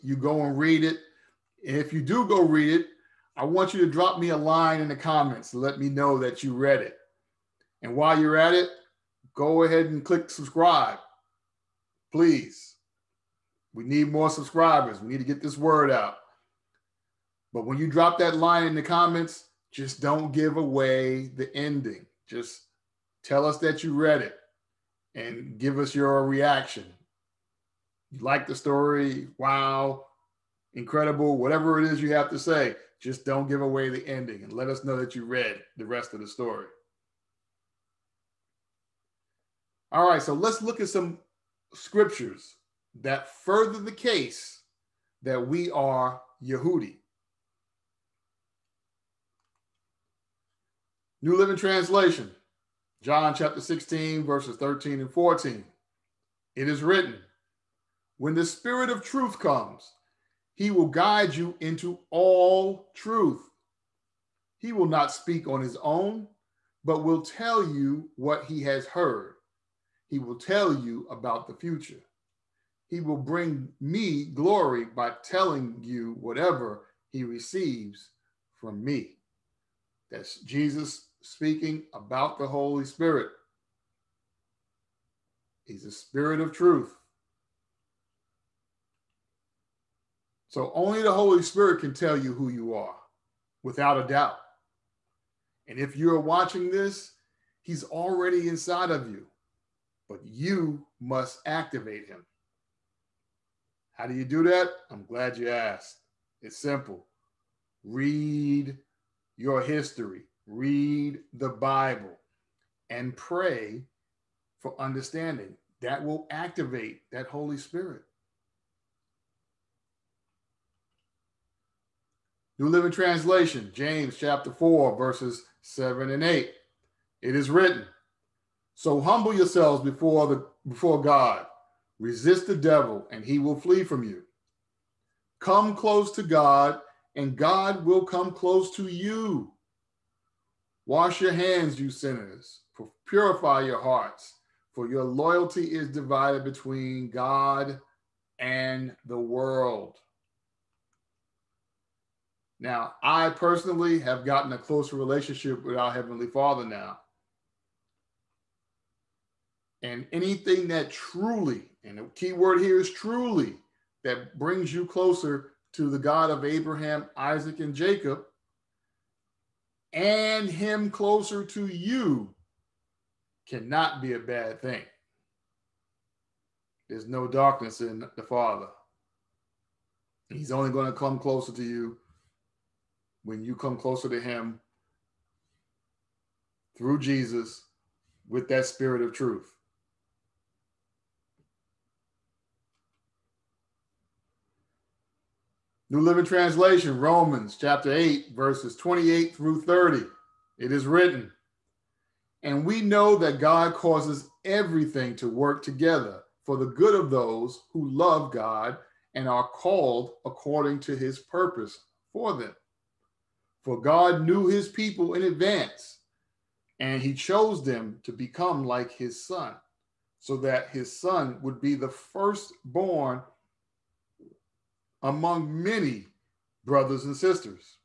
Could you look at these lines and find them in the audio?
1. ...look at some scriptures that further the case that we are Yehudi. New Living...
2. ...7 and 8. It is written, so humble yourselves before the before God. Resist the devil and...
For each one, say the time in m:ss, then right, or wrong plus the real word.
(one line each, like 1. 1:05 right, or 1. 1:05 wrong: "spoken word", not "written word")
1. 0:40 right
2. 2:05 right.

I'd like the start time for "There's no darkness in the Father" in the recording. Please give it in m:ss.
2:56.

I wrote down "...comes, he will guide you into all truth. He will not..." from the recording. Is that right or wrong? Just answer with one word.
right.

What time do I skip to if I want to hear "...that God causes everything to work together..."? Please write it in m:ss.
3:23.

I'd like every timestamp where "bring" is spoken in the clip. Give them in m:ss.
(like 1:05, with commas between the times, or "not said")
1:13, 2:44.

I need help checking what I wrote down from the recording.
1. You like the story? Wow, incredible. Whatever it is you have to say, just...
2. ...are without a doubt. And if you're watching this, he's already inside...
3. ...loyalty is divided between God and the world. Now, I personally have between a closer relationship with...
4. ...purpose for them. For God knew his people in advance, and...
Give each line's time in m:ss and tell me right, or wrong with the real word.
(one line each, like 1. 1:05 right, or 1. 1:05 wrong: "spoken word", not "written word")
1. 0:28 right
2. 1:32 right
3. 2:25 wrong: "gotten", not "between"
4. 3:31 right.